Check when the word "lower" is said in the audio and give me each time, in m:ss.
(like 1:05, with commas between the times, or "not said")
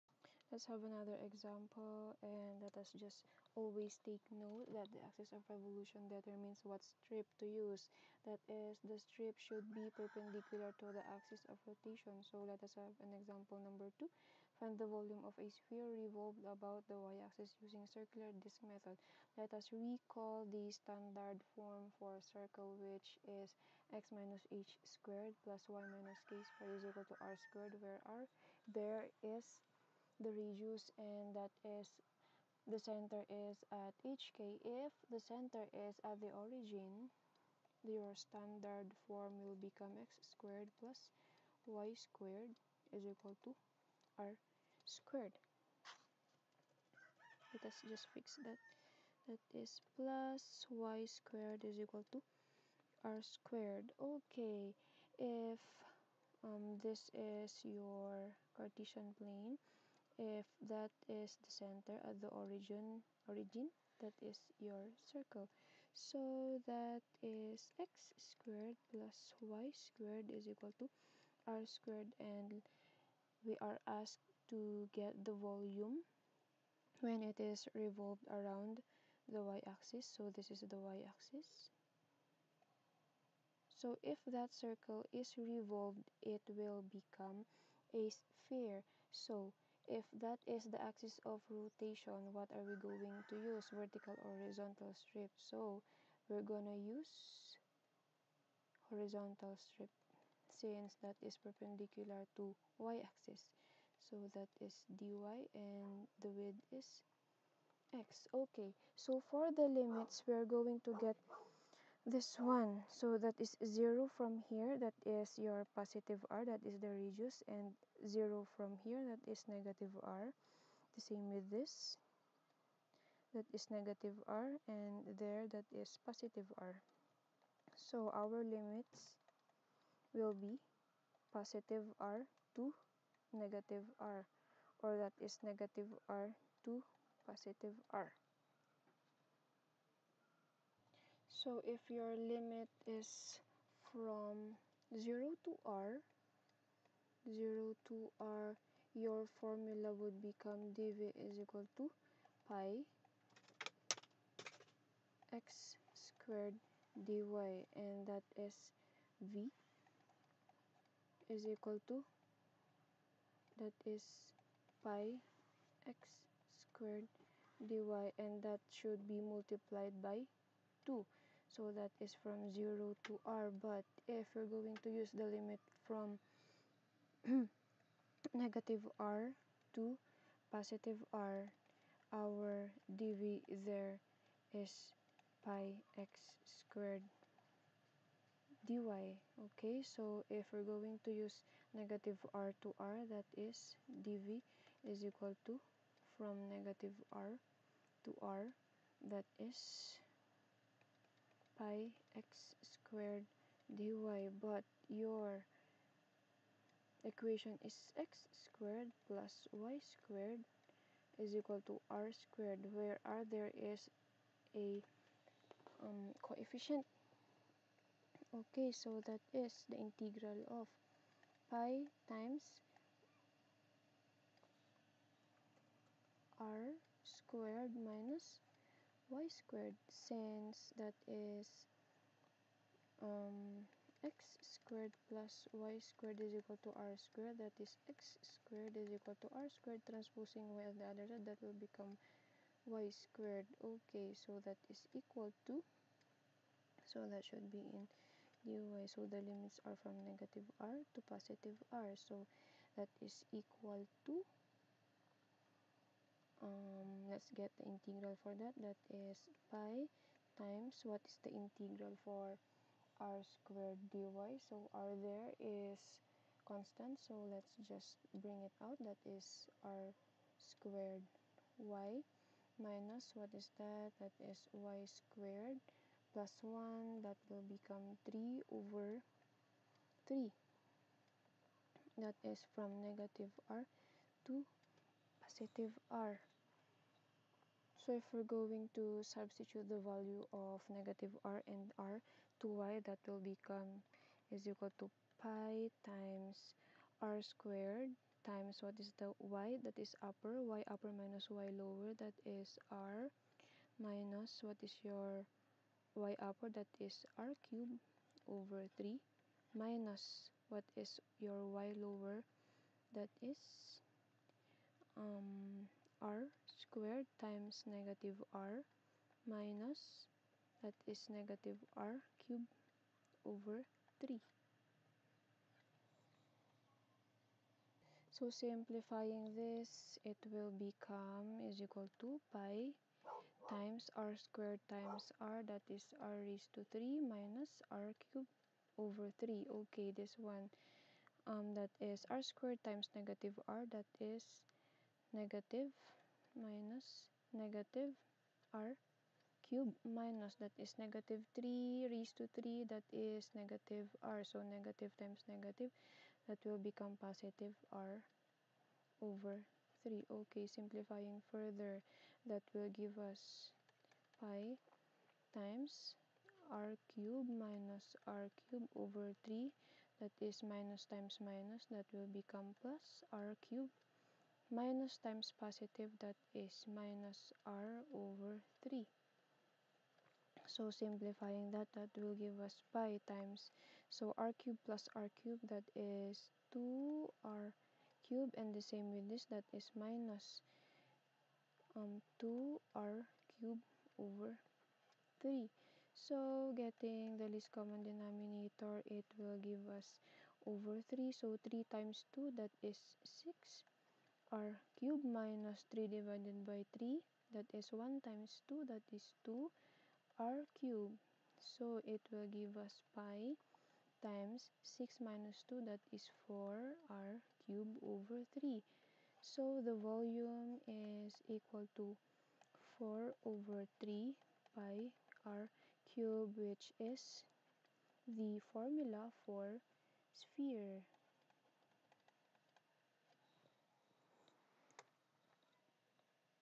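5:01, 5:11.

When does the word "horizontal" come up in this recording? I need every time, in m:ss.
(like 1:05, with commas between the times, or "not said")
1:34, 1:38.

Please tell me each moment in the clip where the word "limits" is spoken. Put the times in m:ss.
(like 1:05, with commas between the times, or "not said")
1:49, 2:08, 2:22, 2:55, 4:09.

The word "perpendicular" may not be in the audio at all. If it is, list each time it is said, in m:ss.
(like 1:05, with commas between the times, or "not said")
0:09, 1:41.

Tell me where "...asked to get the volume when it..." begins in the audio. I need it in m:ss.
1:13.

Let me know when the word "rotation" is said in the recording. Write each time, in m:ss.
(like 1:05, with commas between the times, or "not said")
0:11, 1:31.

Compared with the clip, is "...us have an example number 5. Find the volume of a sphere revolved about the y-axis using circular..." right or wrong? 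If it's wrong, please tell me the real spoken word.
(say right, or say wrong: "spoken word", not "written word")
wrong: "2", not "5".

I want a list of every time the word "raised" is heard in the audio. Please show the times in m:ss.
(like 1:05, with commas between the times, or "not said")
5:36, 5:51.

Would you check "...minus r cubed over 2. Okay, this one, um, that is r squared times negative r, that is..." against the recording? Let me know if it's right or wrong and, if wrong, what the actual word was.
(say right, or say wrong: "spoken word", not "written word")
wrong: "3", not "2".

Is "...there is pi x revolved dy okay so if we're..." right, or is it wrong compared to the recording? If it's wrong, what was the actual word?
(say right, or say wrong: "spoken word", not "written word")
wrong: "squared", not "revolved".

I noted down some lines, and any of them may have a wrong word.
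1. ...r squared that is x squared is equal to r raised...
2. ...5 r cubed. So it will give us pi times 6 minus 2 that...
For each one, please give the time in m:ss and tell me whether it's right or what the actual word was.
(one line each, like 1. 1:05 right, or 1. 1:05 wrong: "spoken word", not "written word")
1. 3:56 wrong: "squared", not "raised"
2. 6:49 wrong: "2", not "5".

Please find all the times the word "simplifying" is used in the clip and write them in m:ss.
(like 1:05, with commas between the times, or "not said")
5:28, 6:00, 6:20.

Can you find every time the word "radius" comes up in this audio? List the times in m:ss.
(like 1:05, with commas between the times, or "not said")
0:30, 1:56.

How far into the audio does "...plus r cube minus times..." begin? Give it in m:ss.
6:12.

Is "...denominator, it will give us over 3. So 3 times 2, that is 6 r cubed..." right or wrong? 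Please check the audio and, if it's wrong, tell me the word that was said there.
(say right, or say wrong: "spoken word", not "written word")
right.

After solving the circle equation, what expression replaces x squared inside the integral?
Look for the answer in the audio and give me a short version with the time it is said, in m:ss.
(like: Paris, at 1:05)
r squared minus y squared, at 3:46.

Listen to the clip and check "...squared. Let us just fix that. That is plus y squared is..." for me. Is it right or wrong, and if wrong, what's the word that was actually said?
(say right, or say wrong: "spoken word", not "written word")
right.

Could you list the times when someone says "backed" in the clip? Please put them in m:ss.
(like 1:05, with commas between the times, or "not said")
not said.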